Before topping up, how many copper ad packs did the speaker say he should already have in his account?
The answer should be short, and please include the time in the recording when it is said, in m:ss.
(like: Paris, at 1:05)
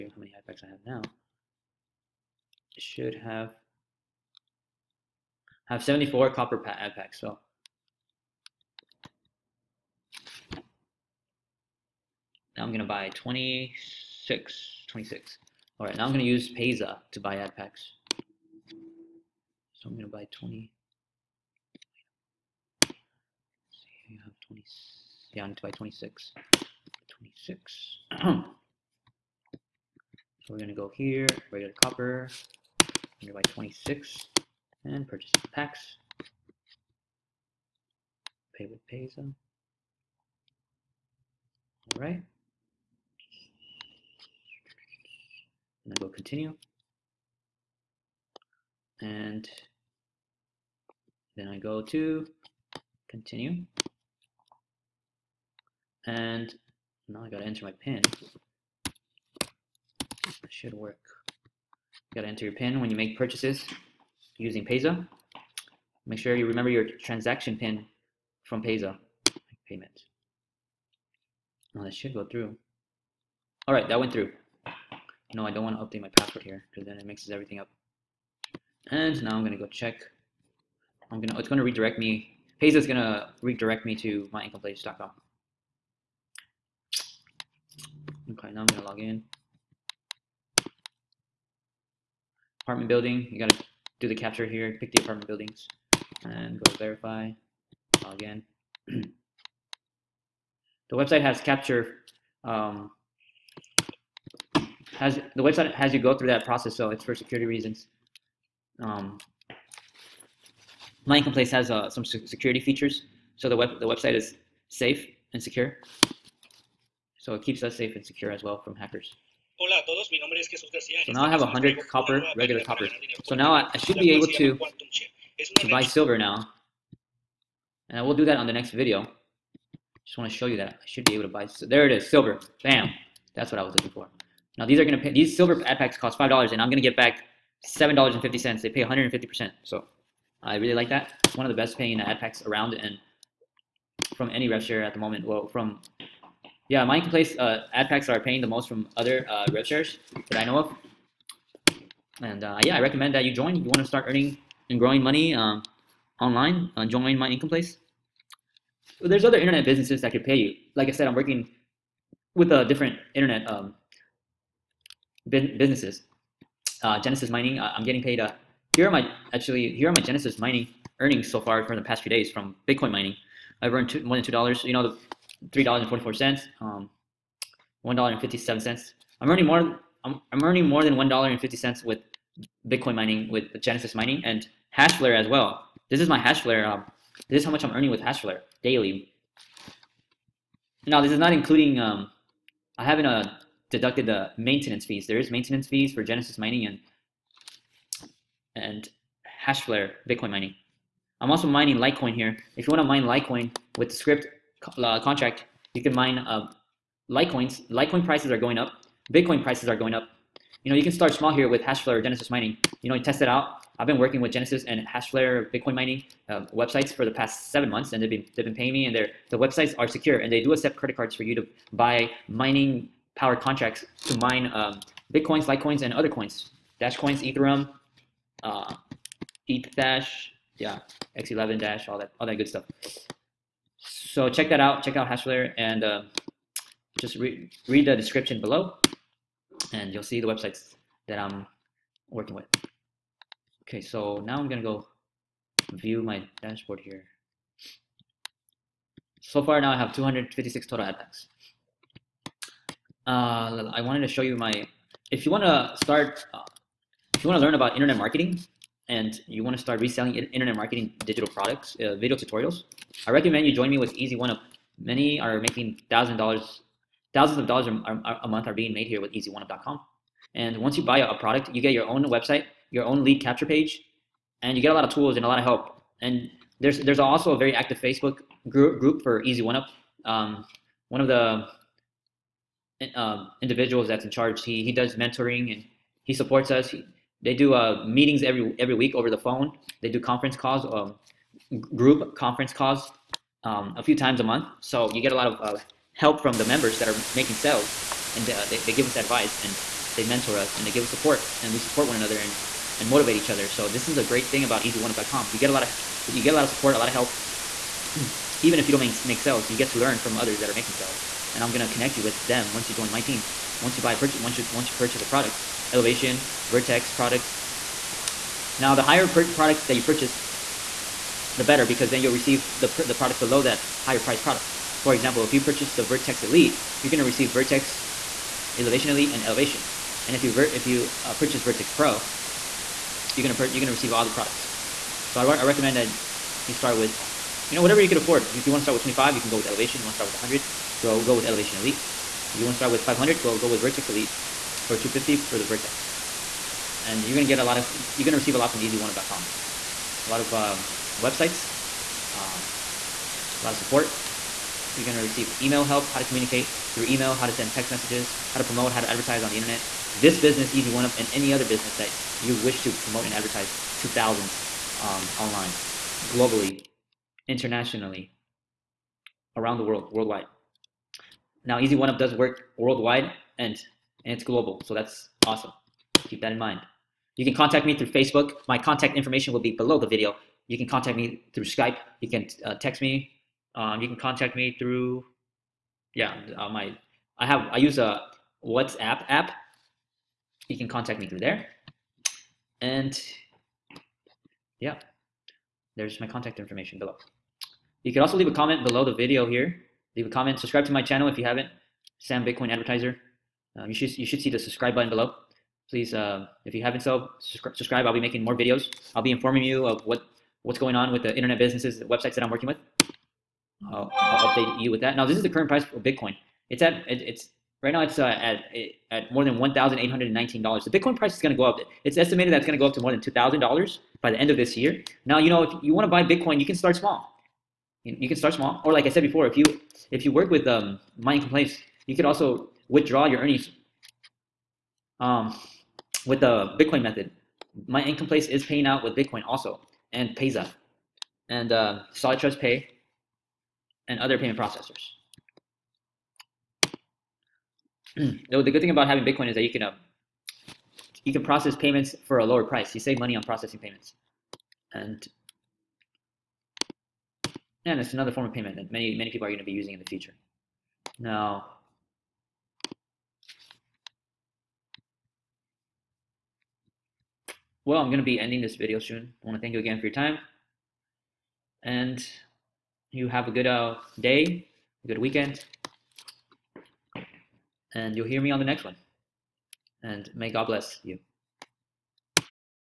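74, at 0:05.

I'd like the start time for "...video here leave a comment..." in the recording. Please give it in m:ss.
6:38.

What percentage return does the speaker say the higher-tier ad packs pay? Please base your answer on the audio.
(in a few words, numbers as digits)
150 percent.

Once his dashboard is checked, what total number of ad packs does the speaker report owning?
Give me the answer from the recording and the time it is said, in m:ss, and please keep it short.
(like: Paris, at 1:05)
256, at 4:09.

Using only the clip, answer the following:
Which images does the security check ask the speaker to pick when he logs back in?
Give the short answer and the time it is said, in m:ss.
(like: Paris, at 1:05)
Apartment buildings, at 1:34.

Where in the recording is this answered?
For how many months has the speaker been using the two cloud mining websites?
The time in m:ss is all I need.
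3:37.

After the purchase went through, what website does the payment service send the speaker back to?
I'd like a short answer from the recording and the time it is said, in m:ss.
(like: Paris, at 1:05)
myincomeplace.com, at 1:24.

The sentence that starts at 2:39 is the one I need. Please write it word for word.
There's other internet businesses that could pay you.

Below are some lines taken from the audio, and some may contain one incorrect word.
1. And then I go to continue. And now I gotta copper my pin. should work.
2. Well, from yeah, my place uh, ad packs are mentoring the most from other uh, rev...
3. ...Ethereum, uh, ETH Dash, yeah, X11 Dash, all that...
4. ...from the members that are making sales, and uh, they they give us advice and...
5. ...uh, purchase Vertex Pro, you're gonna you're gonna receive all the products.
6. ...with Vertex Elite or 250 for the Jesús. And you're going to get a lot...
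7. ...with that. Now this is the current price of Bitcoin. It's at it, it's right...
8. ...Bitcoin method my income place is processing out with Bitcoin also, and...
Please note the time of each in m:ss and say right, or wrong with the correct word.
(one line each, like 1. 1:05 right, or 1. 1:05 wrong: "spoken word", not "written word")
1. 0:49 wrong: "enter", not "copper"
2. 2:25 wrong: "paying", not "mentoring"
3. 3:47 right
4. 4:56 right
5. 5:31 right
6. 5:43 wrong: "Vertex", not "Jesús"
7. 6:54 right
8. 7:16 wrong: "paying", not "processing".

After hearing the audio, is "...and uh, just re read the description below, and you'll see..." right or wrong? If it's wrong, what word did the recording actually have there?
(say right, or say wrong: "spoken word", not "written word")
right.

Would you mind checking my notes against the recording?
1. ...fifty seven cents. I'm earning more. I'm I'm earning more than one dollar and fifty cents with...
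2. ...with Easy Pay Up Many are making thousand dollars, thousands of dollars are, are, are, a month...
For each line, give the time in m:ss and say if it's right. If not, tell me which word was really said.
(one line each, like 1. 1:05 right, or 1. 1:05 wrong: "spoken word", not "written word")
1. 2:58 right
2. 4:23 wrong: "One", not "Pay".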